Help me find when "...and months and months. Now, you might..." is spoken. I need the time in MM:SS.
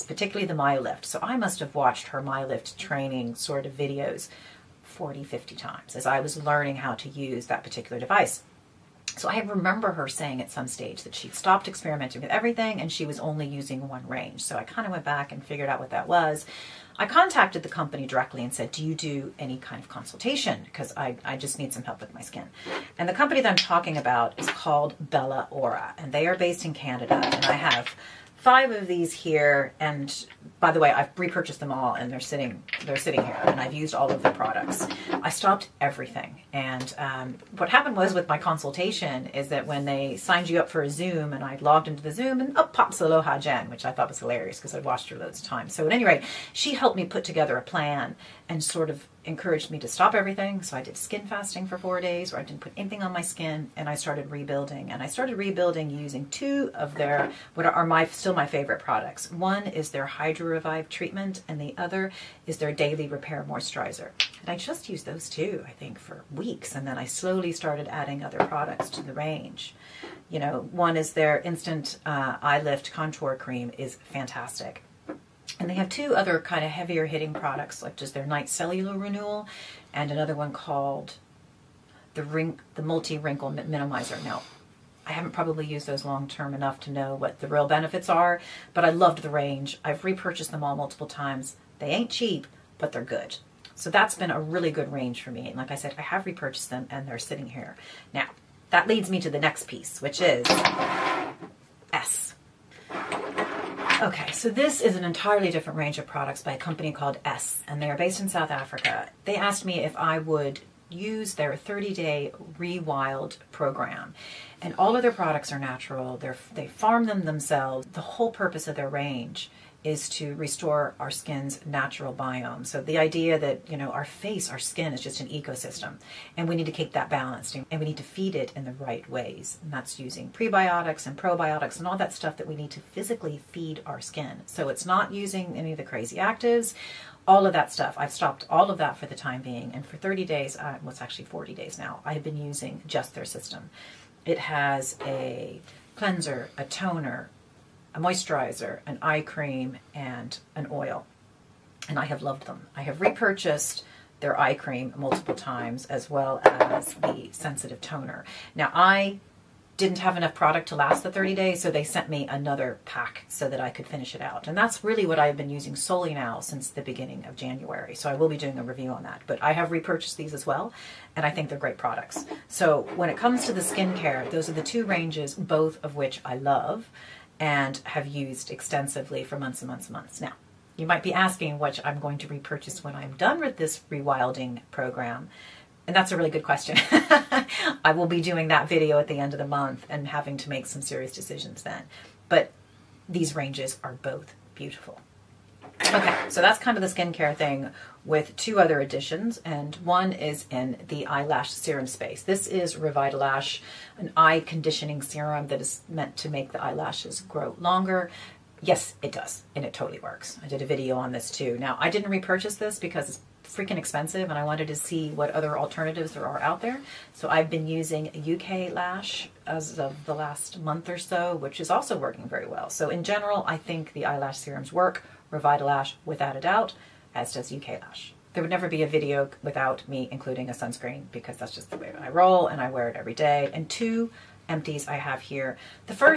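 02:59.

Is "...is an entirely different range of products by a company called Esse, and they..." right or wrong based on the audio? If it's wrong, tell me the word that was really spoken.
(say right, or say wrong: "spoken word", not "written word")
right.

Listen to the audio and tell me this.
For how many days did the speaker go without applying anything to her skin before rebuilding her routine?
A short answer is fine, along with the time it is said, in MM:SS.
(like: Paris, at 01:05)
4, at 00:51.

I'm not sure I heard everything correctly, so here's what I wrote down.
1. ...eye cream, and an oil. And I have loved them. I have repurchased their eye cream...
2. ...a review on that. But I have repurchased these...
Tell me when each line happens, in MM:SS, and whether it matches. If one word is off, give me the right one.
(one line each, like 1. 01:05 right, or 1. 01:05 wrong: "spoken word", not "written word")
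1. 02:29 right
2. 02:48 right.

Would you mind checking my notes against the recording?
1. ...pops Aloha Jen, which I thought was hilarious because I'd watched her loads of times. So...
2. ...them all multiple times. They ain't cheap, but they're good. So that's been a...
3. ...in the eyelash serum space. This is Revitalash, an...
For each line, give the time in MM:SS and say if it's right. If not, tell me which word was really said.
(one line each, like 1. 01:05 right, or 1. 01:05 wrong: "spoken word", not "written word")
1. 00:42 right
2. 01:30 right
3. 03:20 right.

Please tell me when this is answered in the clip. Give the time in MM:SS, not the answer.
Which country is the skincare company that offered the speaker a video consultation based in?
00:26.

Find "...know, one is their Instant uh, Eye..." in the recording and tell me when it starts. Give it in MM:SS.
01:10.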